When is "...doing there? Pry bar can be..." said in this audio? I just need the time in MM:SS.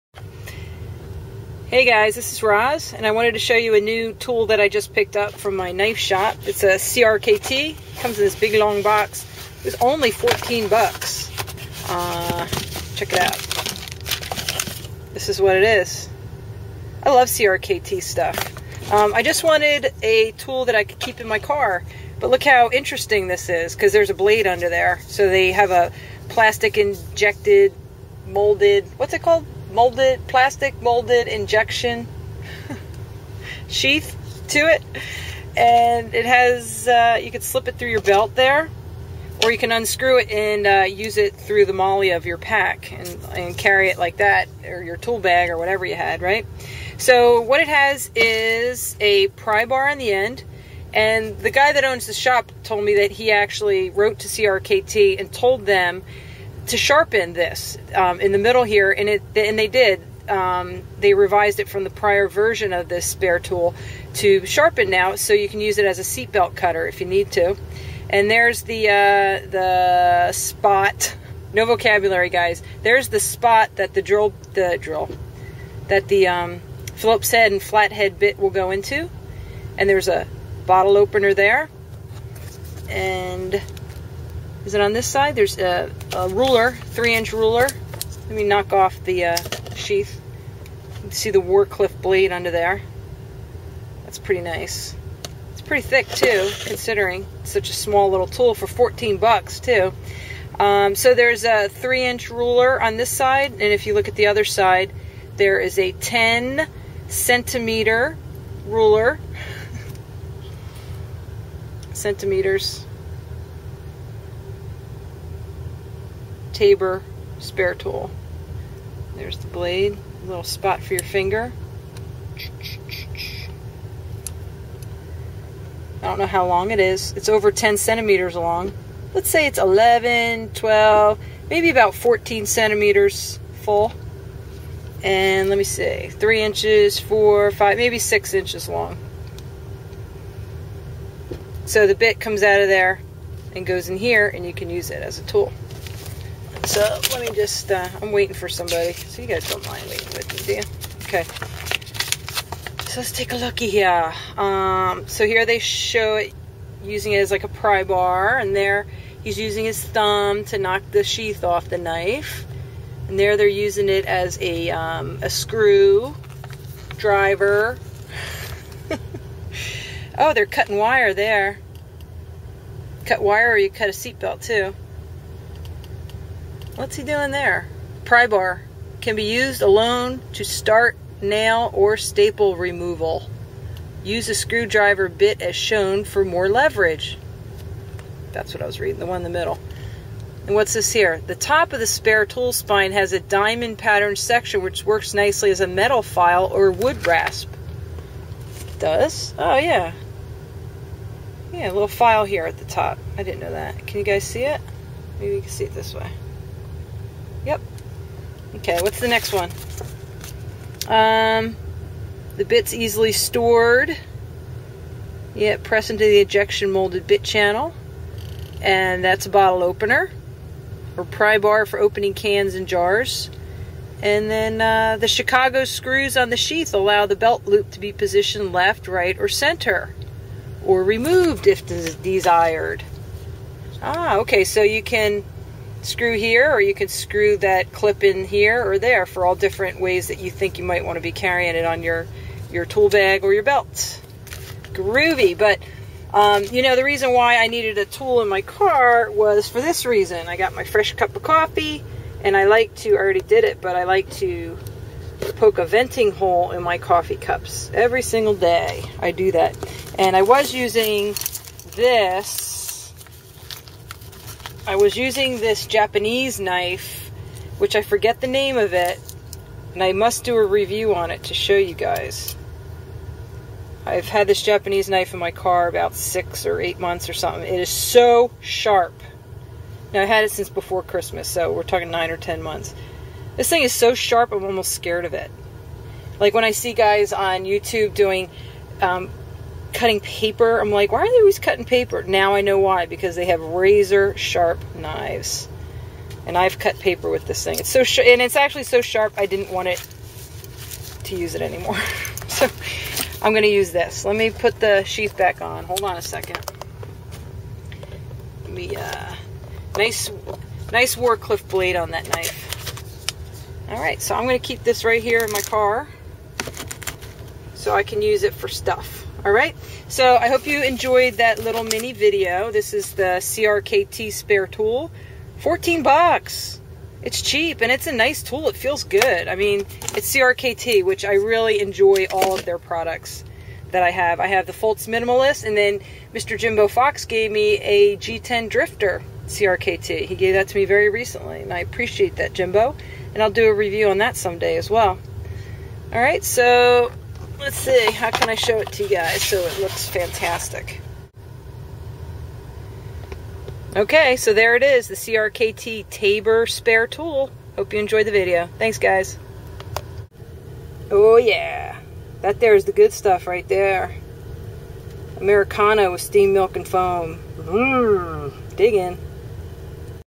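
02:57.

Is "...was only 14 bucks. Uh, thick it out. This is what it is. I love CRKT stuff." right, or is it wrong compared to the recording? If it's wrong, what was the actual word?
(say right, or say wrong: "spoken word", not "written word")
wrong: "check", not "thick".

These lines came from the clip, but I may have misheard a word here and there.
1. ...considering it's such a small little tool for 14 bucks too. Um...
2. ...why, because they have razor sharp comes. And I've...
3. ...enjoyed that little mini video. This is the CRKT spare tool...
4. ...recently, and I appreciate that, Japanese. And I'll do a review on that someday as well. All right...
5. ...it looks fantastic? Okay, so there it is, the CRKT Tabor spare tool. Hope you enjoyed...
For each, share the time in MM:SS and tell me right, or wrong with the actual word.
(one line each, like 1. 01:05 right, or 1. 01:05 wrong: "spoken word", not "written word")
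1. 01:36 right
2. 04:52 wrong: "knives", not "comes"
3. 05:20 right
4. 05:40 wrong: "Jimbo", not "Japanese"
5. 05:49 right.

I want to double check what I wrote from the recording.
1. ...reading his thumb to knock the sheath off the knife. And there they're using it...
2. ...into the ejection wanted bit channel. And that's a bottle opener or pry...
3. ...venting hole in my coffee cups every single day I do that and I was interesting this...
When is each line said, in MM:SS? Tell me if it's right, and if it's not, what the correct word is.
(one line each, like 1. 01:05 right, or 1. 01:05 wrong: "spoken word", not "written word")
1. 02:39 wrong: "using", not "reading"
2. 03:35 wrong: "molded", not "wanted"
3. 04:15 wrong: "using", not "interesting".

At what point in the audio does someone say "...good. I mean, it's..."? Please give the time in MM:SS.
05:28.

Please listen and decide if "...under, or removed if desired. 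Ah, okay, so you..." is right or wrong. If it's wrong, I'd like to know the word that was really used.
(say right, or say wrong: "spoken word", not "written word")
wrong: "center", not "under".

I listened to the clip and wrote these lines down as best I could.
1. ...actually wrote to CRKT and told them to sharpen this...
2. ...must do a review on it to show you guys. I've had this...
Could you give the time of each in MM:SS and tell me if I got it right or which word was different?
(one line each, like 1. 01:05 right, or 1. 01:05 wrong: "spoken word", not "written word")
1. 00:53 right
2. 04:29 right.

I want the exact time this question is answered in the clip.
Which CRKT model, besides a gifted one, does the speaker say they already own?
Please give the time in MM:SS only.
05:34.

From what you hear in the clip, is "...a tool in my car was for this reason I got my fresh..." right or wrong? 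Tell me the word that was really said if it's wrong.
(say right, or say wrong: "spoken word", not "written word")
right.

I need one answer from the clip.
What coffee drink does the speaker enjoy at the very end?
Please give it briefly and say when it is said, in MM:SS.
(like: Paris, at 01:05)
Americano, at 06:05.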